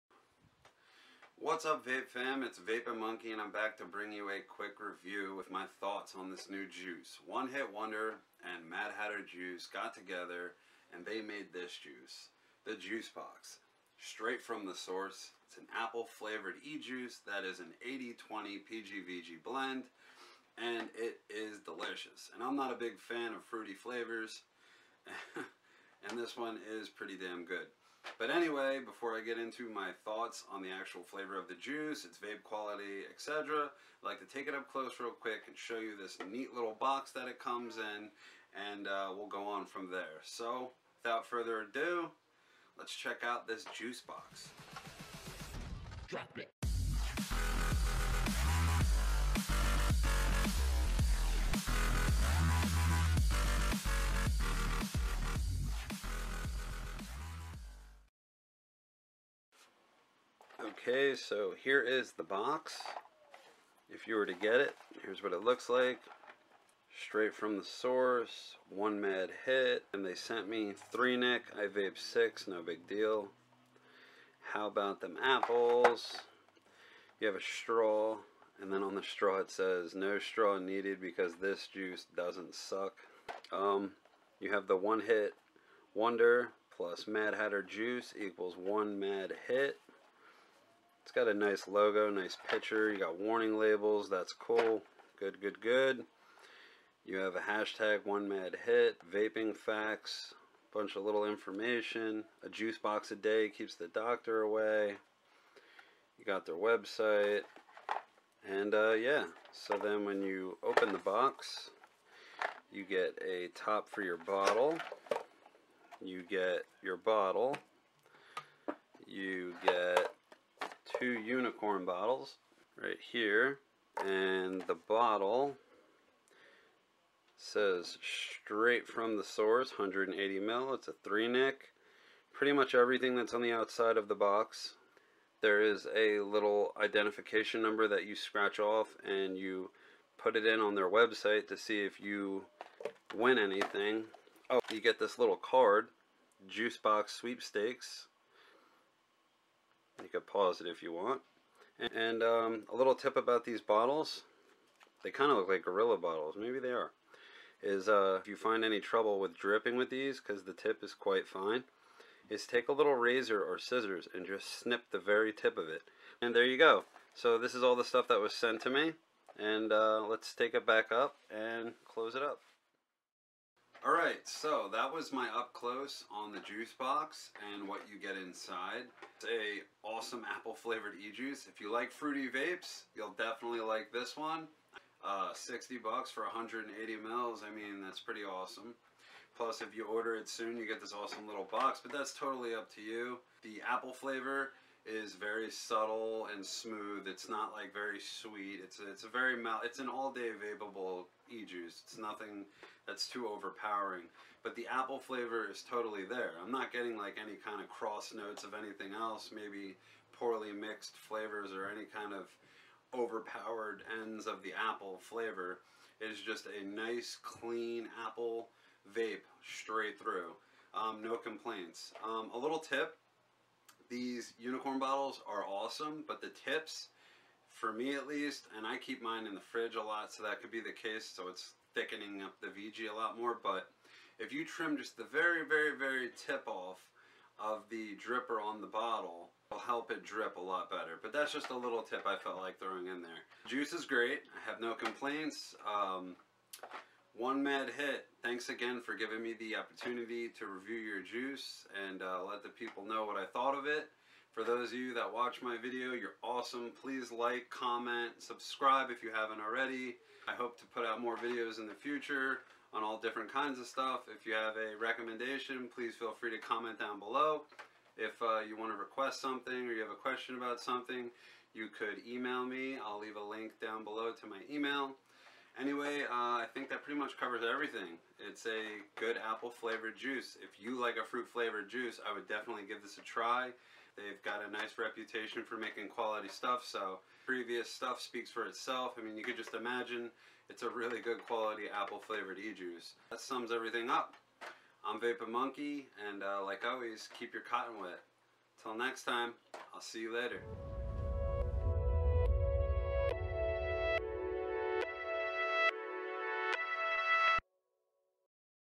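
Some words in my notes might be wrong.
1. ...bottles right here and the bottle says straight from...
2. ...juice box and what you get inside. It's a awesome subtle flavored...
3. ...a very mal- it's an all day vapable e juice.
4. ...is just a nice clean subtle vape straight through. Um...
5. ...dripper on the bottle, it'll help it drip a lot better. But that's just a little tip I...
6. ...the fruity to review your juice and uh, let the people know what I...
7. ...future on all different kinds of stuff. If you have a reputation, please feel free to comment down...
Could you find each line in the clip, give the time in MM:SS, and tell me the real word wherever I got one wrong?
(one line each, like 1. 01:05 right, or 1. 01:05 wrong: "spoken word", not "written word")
1. 02:01 right
2. 02:56 wrong: "apple", not "subtle"
3. 03:19 right
4. 03:36 wrong: "apple", not "subtle"
5. 03:57 right
6. 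04:09 wrong: "opportunity", not "fruity"
7. 04:21 wrong: "recommendation", not "reputation".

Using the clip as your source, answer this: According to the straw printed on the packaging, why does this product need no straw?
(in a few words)
this juice doesn't suck.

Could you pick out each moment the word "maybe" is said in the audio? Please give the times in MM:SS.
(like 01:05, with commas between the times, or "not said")
02:36, 03:29.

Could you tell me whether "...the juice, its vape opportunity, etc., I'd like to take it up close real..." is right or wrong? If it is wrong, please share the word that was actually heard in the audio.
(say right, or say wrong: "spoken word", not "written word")
wrong: "quality", not "opportunity".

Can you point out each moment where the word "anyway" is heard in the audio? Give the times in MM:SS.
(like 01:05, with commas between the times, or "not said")
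00:28, 04:35.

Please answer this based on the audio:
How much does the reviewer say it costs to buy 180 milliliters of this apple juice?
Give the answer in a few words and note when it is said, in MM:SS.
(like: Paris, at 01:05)
$60, at 03:05.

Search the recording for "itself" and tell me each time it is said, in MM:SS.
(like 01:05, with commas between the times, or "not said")
04:48.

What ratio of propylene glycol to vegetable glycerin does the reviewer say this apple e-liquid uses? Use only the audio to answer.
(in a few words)
80-20.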